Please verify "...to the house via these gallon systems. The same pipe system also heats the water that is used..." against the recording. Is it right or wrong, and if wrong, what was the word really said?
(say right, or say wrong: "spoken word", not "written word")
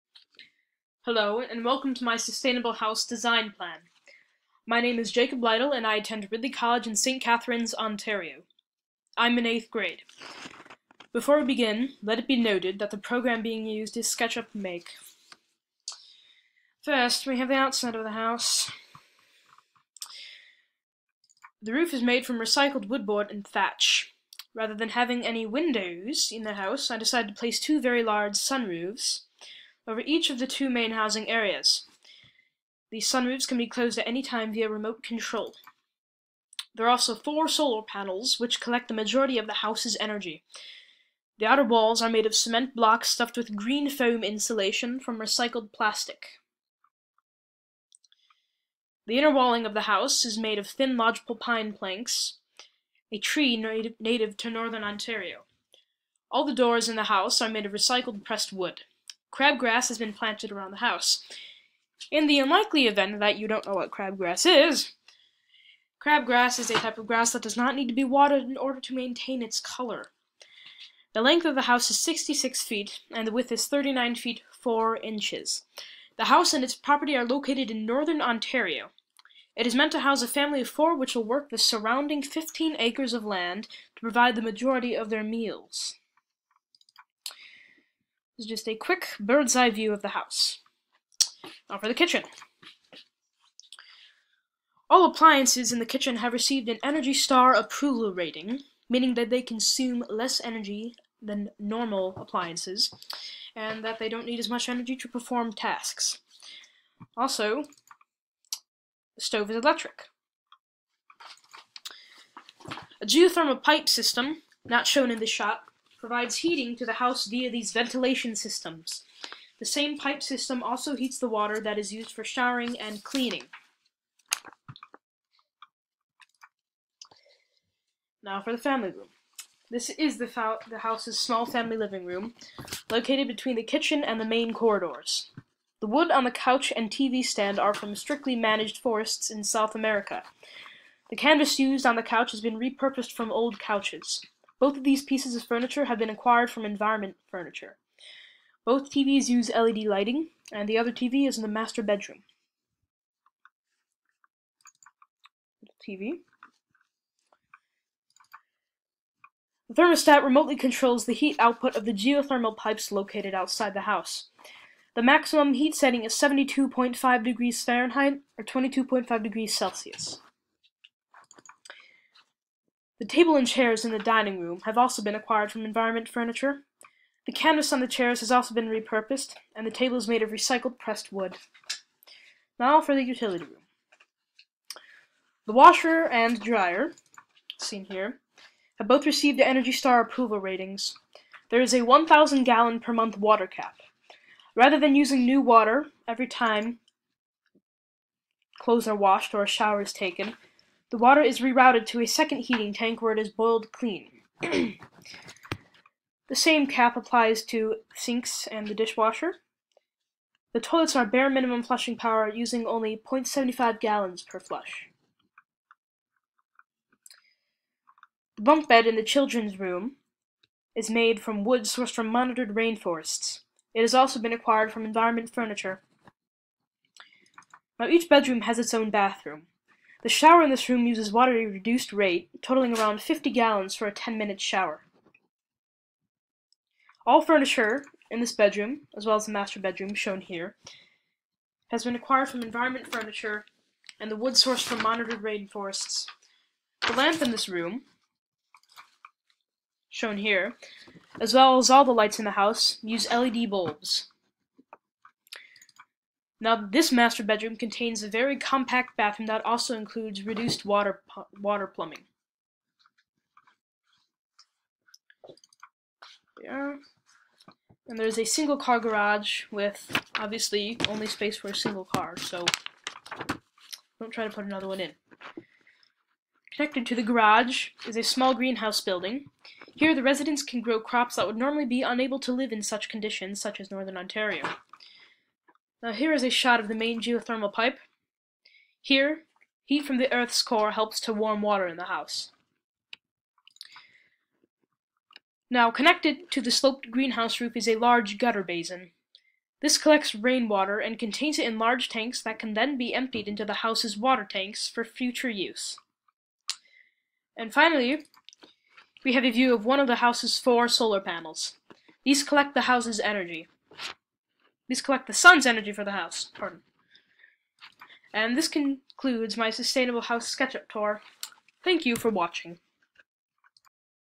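wrong: "ventilation", not "gallon".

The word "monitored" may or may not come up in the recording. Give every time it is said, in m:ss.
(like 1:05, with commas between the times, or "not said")
3:42, 4:04.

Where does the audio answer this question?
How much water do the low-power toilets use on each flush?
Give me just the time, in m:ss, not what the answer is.
3:33.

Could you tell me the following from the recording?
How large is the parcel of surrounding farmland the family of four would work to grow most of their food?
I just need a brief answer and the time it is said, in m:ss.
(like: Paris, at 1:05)
15 acres, at 1:22.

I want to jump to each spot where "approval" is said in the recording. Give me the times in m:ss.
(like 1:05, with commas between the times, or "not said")
1:37, 3:10.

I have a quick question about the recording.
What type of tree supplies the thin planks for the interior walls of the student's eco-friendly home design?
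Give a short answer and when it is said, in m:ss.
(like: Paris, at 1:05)
lodgepole pine, at 0:50.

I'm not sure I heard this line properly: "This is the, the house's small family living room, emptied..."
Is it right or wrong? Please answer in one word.
wrong.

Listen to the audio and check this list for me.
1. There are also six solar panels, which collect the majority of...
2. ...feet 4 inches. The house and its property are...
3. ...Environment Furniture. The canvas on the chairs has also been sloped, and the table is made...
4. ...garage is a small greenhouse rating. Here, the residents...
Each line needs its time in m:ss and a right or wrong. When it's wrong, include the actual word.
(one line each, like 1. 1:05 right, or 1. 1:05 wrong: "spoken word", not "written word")
1. 0:36 wrong: "four", not "six"
2. 1:14 right
3. 2:55 wrong: "repurposed", not "sloped"
4. 4:37 wrong: "building", not "rating".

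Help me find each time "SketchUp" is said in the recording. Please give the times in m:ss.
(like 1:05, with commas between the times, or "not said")
0:14, 5:20.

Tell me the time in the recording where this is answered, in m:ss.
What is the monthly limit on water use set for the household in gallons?
3:11.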